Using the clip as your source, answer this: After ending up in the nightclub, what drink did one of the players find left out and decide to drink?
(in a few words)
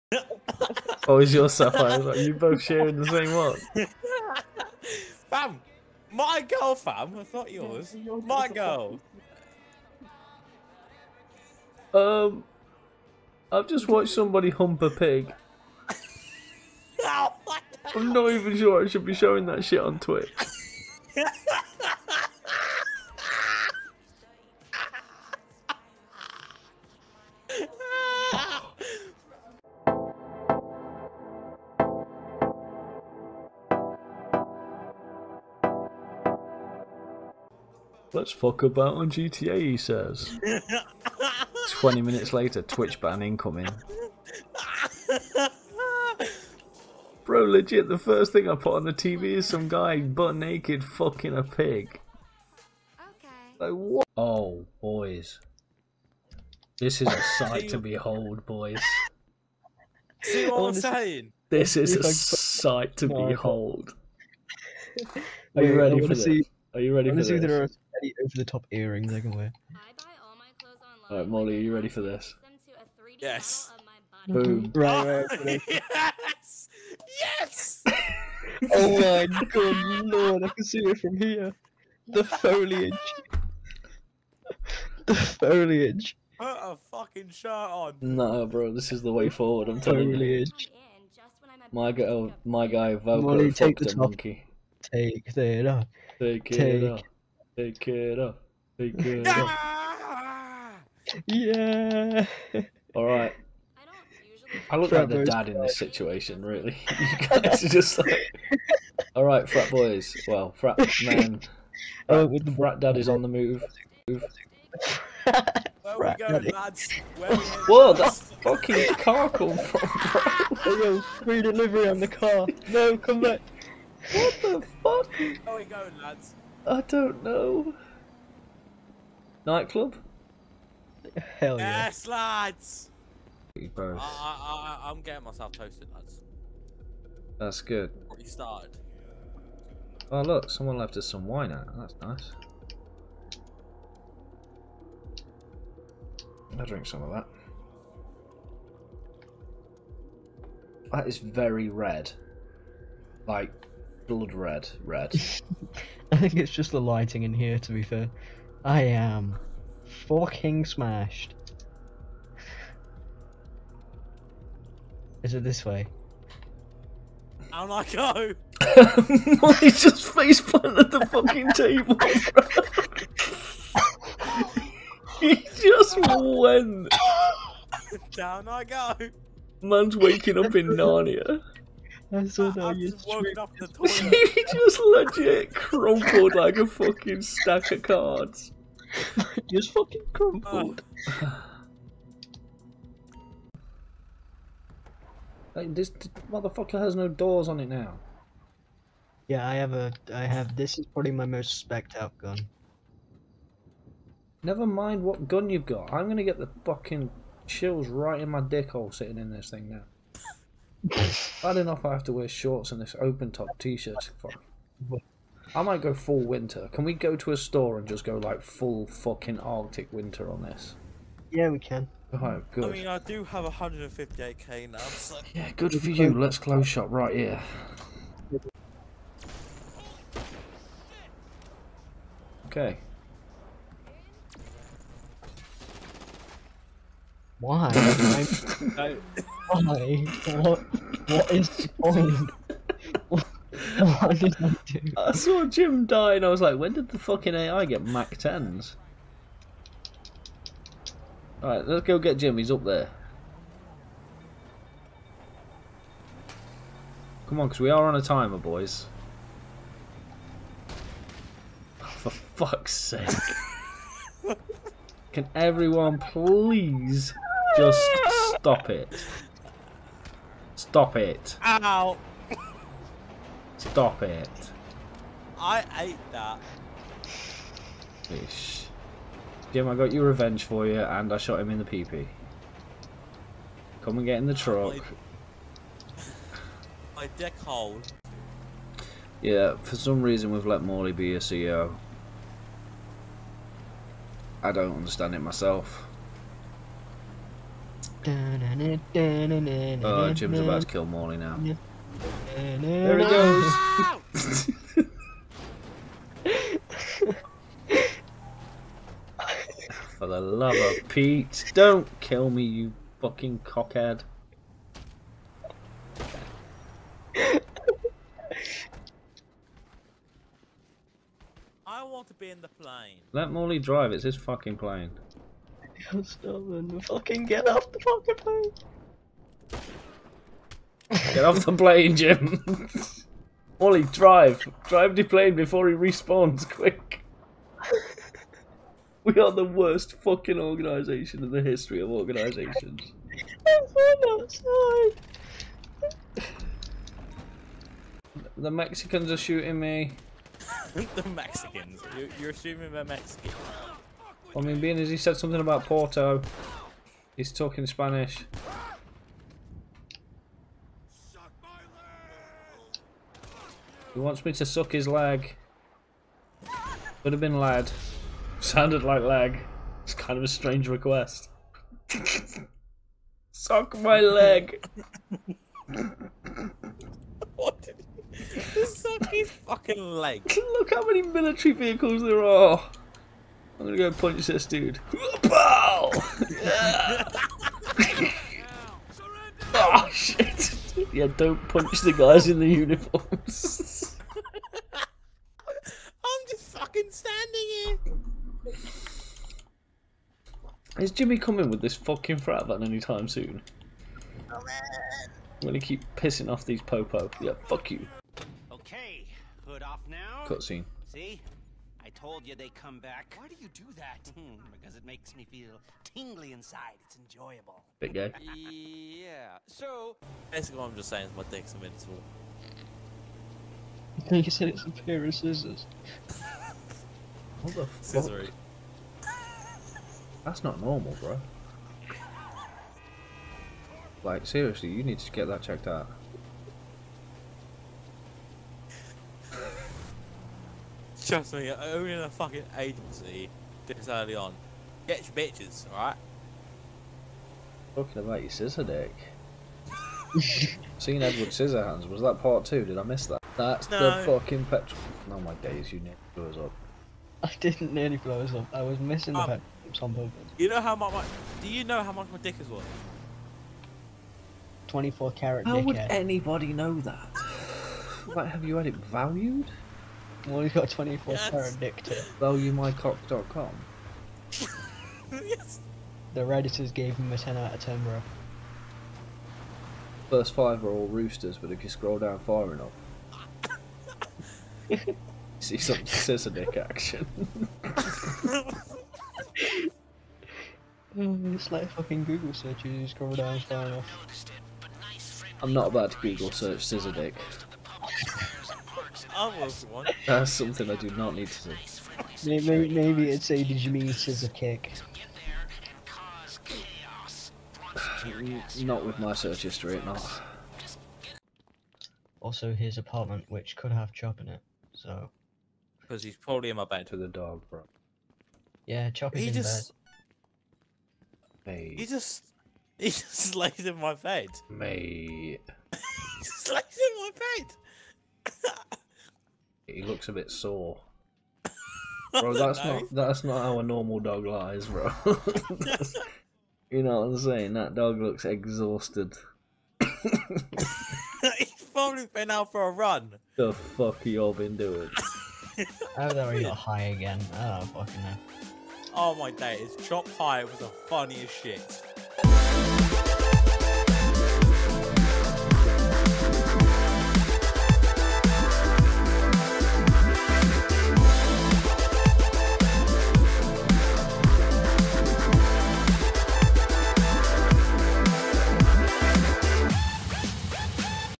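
wine.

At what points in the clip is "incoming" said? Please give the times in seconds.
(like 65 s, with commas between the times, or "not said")
43 s.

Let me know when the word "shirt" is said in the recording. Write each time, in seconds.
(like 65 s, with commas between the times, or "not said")
87 s, 213 s.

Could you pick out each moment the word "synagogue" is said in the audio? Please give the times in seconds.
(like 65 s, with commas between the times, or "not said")
not said.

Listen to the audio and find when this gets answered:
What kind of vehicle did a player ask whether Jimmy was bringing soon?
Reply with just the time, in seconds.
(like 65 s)
402 s.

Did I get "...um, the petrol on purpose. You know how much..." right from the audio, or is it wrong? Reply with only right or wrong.
right.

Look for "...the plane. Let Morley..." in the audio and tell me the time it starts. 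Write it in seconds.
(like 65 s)
322 s.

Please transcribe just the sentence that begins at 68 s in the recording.
any over the top earrings I can wear.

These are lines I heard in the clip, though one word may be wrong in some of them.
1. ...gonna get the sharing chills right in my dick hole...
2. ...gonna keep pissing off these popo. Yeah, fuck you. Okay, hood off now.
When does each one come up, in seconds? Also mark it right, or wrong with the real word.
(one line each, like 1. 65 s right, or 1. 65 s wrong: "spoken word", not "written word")
1. 206 s wrong: "fucking", not "sharing"
2. 405 s right.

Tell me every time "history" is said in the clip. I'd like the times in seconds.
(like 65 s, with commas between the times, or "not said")
341 s, 509 s.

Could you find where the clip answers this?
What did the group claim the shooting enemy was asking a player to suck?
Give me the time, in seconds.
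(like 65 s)
364 s.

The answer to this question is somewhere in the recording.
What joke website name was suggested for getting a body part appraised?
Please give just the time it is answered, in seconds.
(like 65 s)
472 s.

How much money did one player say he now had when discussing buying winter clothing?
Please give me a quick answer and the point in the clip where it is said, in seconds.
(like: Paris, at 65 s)
158k, at 223 s.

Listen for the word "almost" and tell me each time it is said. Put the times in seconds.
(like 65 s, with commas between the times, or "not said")
499 s.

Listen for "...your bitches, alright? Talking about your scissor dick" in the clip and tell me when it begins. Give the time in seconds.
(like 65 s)
445 s.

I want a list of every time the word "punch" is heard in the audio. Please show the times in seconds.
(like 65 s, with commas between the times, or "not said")
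383 s, 391 s.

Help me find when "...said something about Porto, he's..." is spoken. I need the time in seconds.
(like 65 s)
354 s.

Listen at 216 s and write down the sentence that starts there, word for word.
Can we go to a store and just go like full fucking Arctic winter on this?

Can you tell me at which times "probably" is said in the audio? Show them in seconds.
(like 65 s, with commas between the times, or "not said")
200 s, 516 s, 541 s.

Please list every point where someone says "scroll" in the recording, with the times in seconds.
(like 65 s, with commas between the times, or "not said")
481 s, 492 s.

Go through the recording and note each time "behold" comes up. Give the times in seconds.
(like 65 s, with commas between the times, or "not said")
57 s, 63 s.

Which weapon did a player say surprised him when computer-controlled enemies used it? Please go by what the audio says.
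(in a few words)
Mac tens.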